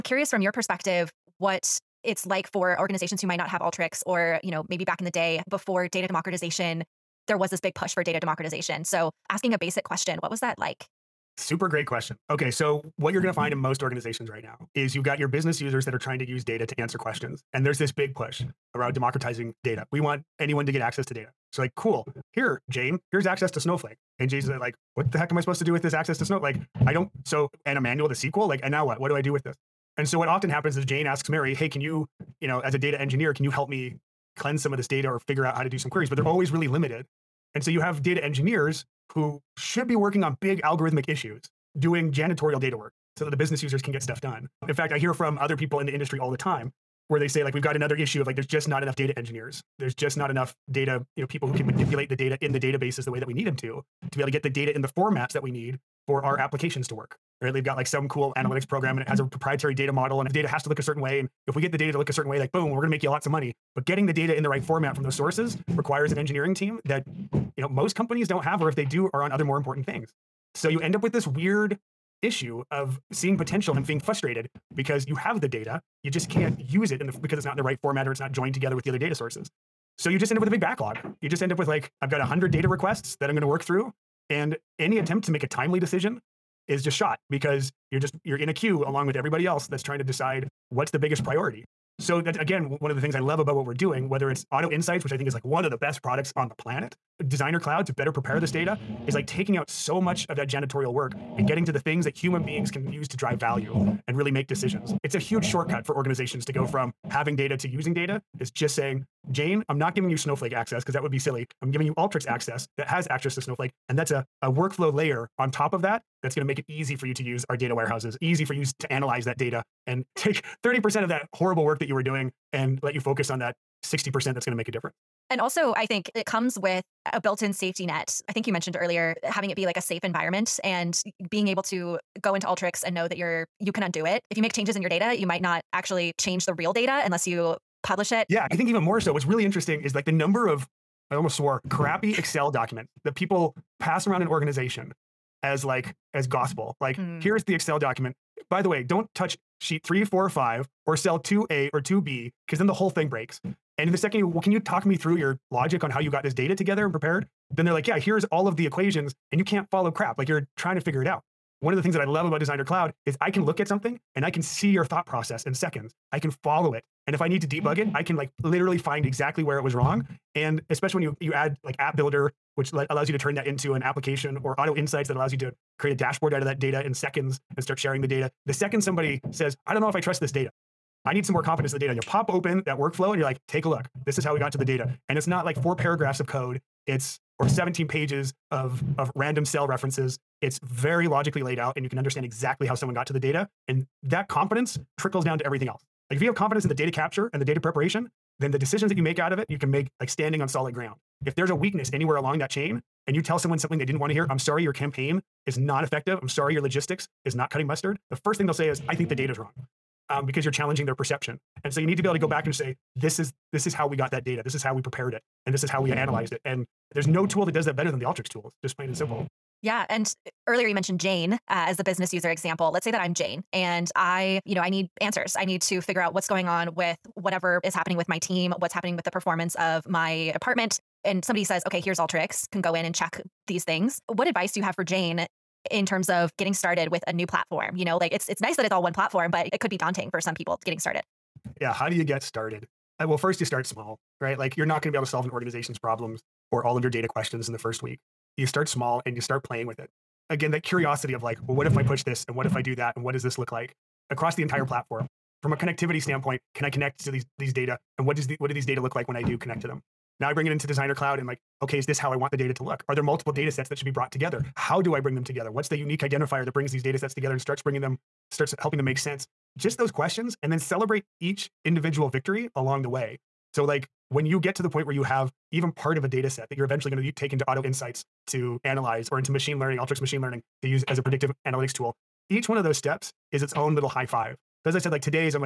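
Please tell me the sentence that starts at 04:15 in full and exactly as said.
From a connectivity standpoint, can I connect to these these data?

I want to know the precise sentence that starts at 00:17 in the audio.
And there's this big push around democratizing data.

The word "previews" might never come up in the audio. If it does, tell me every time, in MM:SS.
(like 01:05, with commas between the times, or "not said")
not said.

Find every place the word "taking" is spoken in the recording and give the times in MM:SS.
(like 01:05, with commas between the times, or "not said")
01:39.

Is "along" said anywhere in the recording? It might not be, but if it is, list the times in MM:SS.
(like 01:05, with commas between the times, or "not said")
01:28, 03:22, 04:32.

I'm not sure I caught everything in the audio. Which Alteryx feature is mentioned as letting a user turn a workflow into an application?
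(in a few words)
App Builder.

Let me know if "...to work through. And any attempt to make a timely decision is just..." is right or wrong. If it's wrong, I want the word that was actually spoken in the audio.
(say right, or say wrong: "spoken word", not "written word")
right.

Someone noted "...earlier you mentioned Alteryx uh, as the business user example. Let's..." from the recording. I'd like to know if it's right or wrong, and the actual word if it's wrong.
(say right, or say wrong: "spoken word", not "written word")
wrong: "Jane", not "Alteryx".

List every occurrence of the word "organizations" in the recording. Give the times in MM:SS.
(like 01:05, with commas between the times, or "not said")
00:02, 00:13, 01:45, 02:24, 04:05.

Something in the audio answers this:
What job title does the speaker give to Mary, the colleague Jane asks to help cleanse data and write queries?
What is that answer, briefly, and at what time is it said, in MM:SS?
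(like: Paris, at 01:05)
data engineer, at 00:32.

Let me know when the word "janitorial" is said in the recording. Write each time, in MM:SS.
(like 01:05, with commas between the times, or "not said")
00:42, 01:40.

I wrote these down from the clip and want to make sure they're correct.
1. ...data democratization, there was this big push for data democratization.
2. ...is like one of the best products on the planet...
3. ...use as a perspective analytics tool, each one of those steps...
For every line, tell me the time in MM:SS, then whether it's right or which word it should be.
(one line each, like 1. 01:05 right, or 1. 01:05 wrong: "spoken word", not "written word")
1. 00:05 right
2. 01:35 right
3. 04:40 wrong: "predictive", not "perspective".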